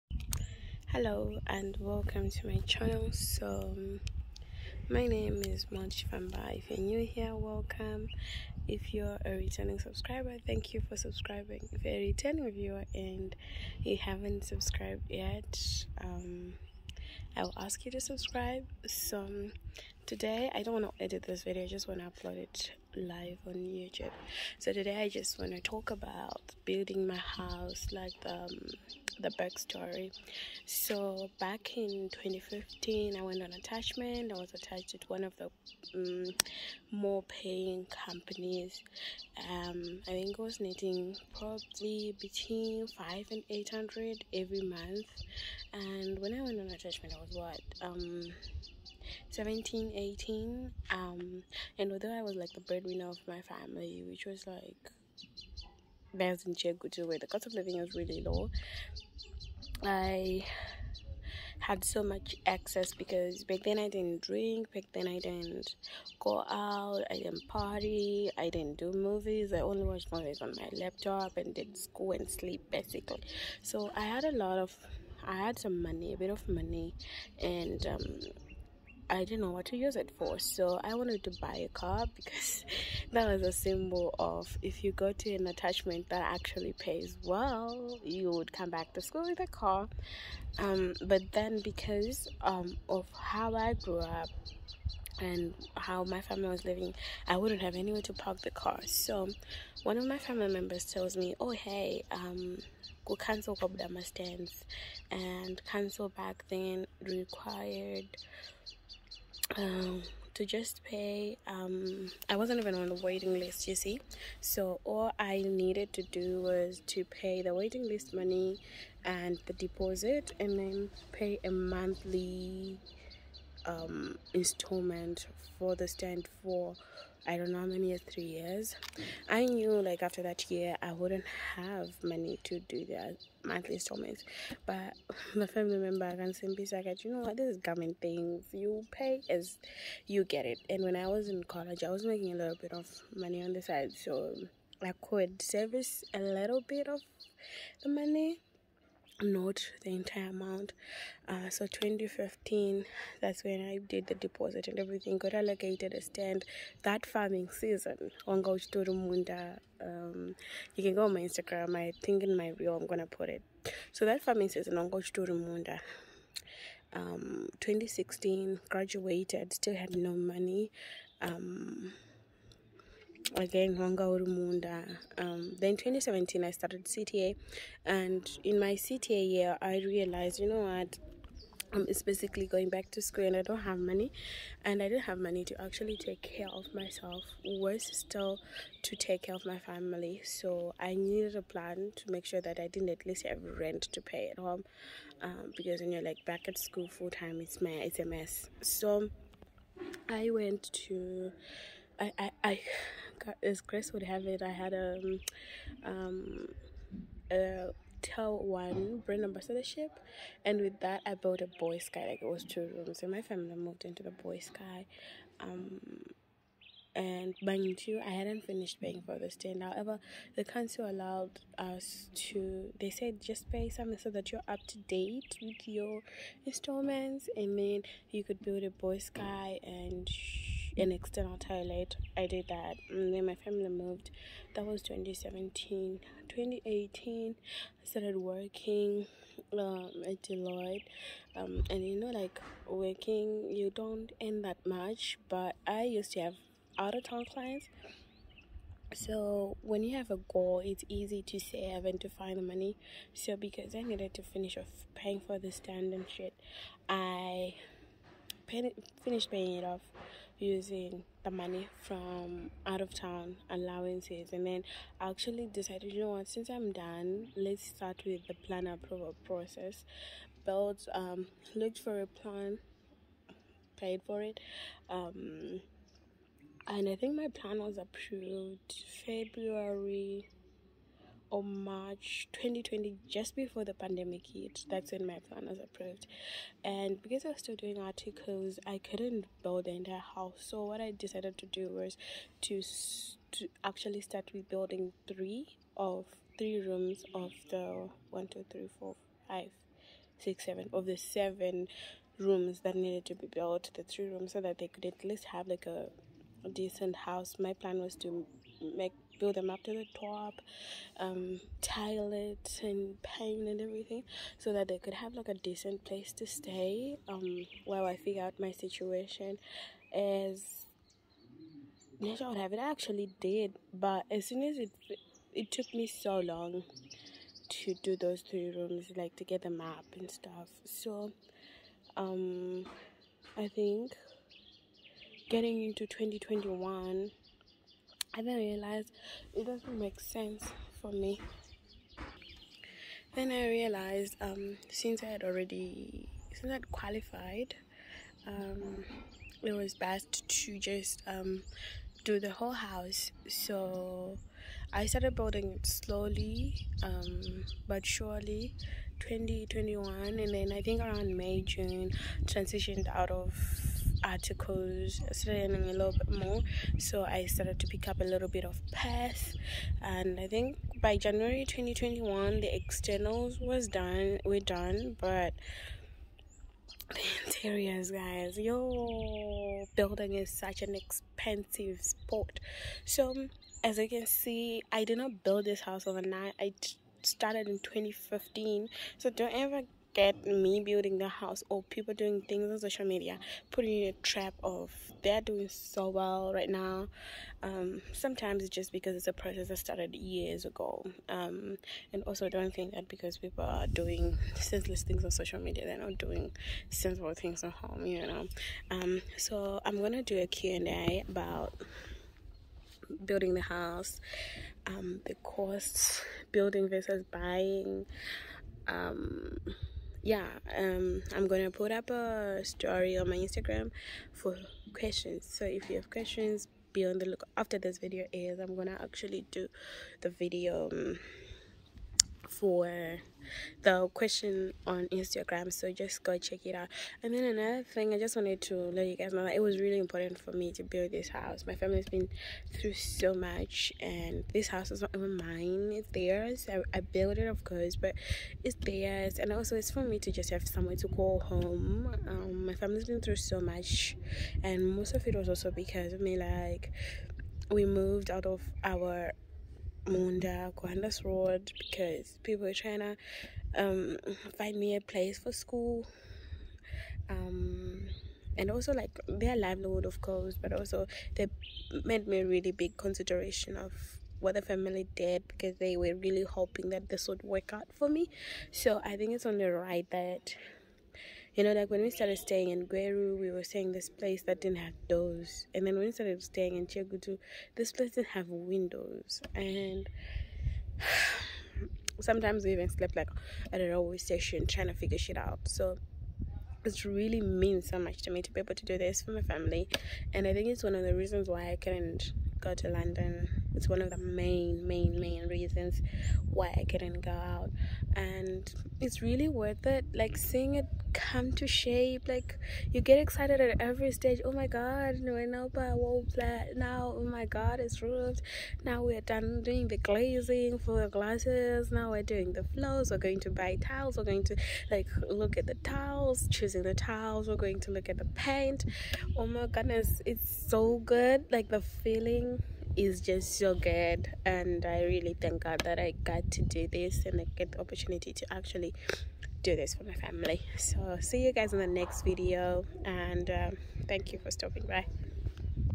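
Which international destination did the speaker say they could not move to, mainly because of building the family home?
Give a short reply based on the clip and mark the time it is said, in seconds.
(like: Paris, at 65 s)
London, at 502 s.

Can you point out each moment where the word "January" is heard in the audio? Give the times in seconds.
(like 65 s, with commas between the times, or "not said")
370 s.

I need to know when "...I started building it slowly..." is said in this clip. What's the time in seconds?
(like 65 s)
354 s.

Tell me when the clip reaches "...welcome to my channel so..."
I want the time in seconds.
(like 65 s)
1 s.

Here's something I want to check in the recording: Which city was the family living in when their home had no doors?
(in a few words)
Gweru.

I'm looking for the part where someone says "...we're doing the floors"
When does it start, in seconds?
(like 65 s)
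521 s.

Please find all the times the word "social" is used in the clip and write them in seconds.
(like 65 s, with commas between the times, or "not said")
392 s, 405 s.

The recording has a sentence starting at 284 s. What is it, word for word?
That's when my plan was approved.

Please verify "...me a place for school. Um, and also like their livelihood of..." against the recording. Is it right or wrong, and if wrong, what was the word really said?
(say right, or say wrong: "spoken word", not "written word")
right.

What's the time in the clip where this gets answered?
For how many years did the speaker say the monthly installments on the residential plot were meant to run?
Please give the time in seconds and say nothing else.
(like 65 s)
128 s.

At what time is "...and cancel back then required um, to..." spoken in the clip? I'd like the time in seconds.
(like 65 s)
105 s.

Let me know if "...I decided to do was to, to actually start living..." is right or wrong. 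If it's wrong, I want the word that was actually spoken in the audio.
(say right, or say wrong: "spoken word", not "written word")
wrong: "rebuilding", not "living".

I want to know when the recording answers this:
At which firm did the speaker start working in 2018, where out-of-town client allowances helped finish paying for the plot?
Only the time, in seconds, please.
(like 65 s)
240 s.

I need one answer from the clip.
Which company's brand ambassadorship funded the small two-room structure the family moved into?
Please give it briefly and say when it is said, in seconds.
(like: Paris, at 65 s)
TelOne, at 208 s.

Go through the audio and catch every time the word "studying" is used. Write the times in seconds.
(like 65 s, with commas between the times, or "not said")
365 s.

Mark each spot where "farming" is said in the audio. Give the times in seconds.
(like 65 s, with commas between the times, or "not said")
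157 s, 164 s.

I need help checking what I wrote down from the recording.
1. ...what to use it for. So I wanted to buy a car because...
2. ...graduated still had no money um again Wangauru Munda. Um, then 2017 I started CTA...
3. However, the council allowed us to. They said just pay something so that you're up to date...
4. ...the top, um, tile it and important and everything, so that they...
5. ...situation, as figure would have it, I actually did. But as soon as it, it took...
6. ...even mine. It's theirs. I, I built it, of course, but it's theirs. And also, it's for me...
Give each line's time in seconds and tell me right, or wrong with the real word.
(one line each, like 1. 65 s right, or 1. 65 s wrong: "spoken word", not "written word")
1. 79 s right
2. 168 s right
3. 219 s right
4. 309 s wrong: "paint", not "important"
5. 318 s wrong: "nature", not "figure"
6. 444 s right.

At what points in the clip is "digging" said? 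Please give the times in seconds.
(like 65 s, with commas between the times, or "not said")
not said.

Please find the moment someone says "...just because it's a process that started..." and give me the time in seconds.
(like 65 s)
398 s.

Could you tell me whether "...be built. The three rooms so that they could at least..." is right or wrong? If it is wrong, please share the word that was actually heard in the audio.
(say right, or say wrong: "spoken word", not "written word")
right.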